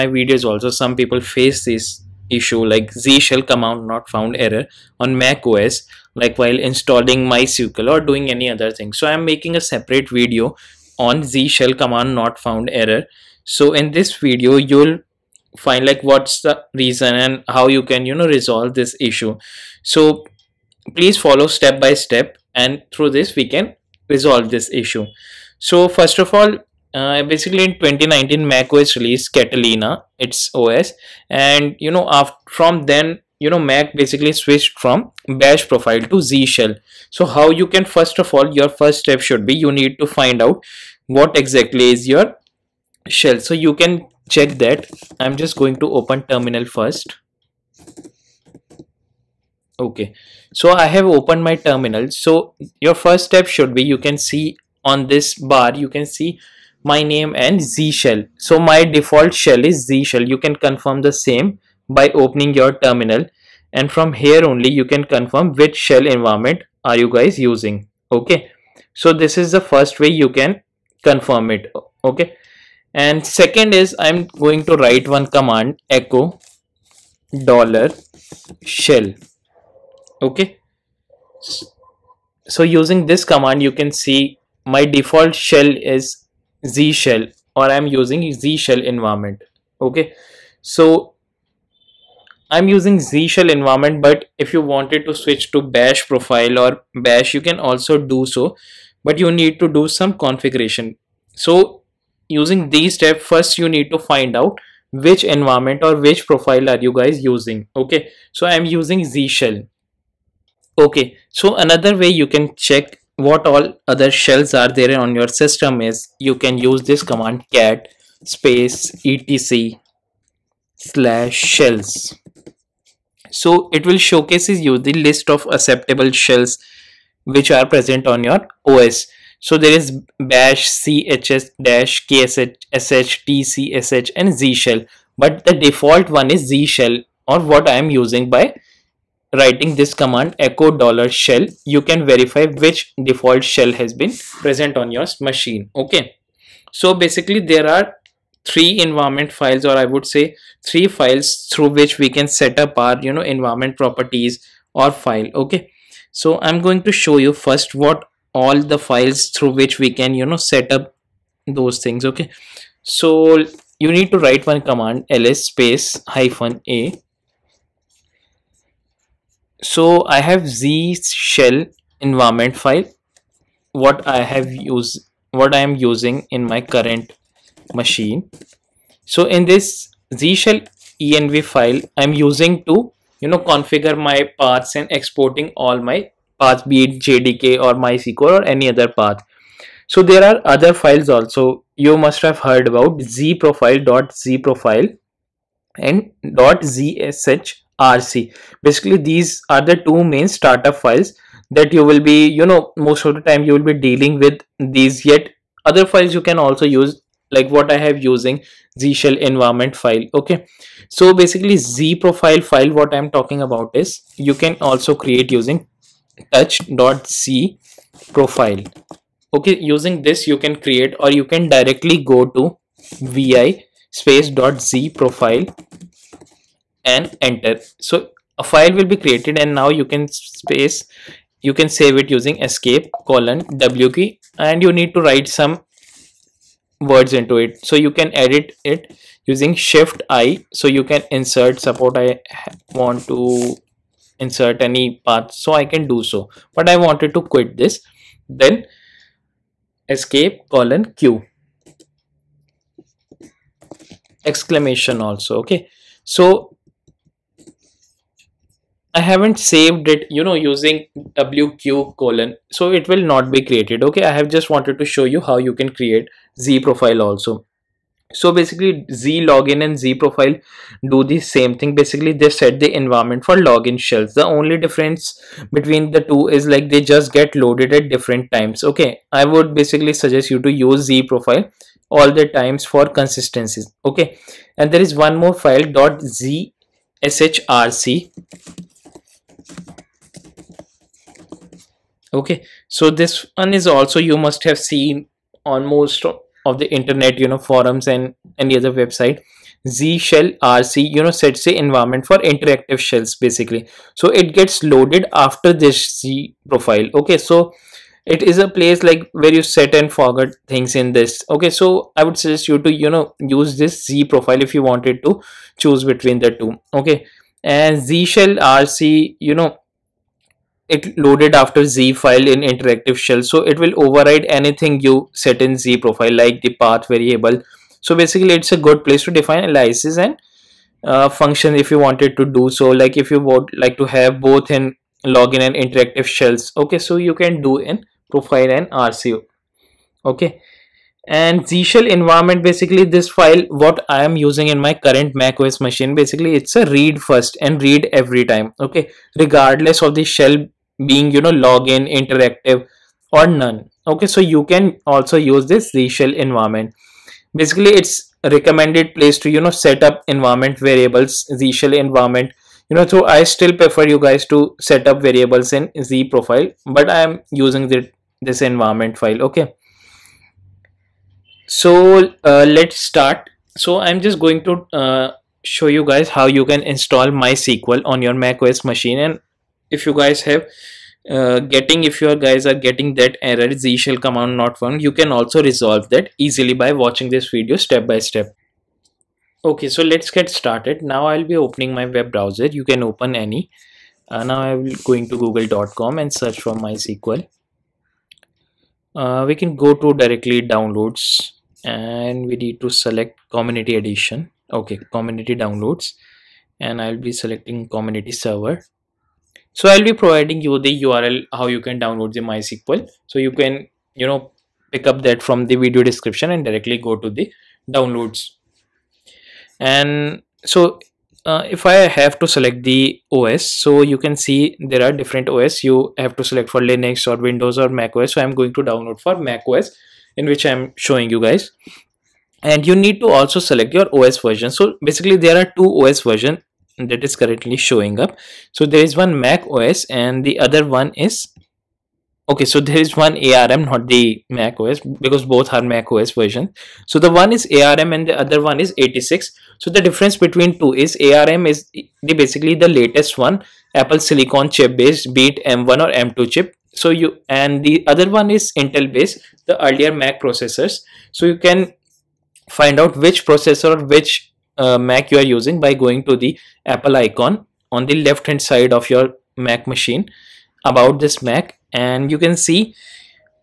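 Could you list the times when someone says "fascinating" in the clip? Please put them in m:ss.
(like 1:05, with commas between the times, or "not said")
not said.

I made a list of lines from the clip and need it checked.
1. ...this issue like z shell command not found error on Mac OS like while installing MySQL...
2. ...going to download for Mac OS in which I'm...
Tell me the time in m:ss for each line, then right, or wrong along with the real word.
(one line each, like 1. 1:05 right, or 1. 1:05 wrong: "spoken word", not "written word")
1. 0:01 right
2. 7:08 right.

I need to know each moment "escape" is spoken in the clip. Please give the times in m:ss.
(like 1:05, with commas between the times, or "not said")
3:52, 4:09.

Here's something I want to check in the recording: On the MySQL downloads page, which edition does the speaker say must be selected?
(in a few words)
Community edition.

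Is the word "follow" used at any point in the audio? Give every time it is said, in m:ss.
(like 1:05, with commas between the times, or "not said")
0:21.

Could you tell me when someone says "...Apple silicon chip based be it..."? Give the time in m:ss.
7:33.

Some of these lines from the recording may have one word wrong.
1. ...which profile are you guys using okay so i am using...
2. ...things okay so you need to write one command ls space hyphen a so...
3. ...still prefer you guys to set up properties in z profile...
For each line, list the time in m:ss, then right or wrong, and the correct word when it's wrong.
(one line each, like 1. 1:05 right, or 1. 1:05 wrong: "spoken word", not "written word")
1. 1:45 right
2. 2:41 right
3. 6:03 wrong: "variables", not "properties".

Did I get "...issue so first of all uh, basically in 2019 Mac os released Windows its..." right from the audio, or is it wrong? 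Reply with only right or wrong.
wrong.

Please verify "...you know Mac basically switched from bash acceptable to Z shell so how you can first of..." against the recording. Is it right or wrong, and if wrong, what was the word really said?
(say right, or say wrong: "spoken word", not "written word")
wrong: "profile", not "acceptable".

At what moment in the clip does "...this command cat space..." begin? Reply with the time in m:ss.
1:56.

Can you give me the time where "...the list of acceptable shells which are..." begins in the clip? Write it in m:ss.
2:04.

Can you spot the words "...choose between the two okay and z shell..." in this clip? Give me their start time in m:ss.
5:15.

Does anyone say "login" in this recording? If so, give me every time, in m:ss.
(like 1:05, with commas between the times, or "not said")
4:29, 4:33, 5:35, 5:51.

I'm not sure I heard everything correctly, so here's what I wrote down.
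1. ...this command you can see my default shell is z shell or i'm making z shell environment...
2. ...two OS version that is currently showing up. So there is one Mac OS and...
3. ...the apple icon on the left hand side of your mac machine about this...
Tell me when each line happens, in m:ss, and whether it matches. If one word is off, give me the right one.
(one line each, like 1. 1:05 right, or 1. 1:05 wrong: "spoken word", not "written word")
1. 1:23 wrong: "using", not "making"
2. 7:15 right
3. 7:46 right.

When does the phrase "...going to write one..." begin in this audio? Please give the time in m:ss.
1:14.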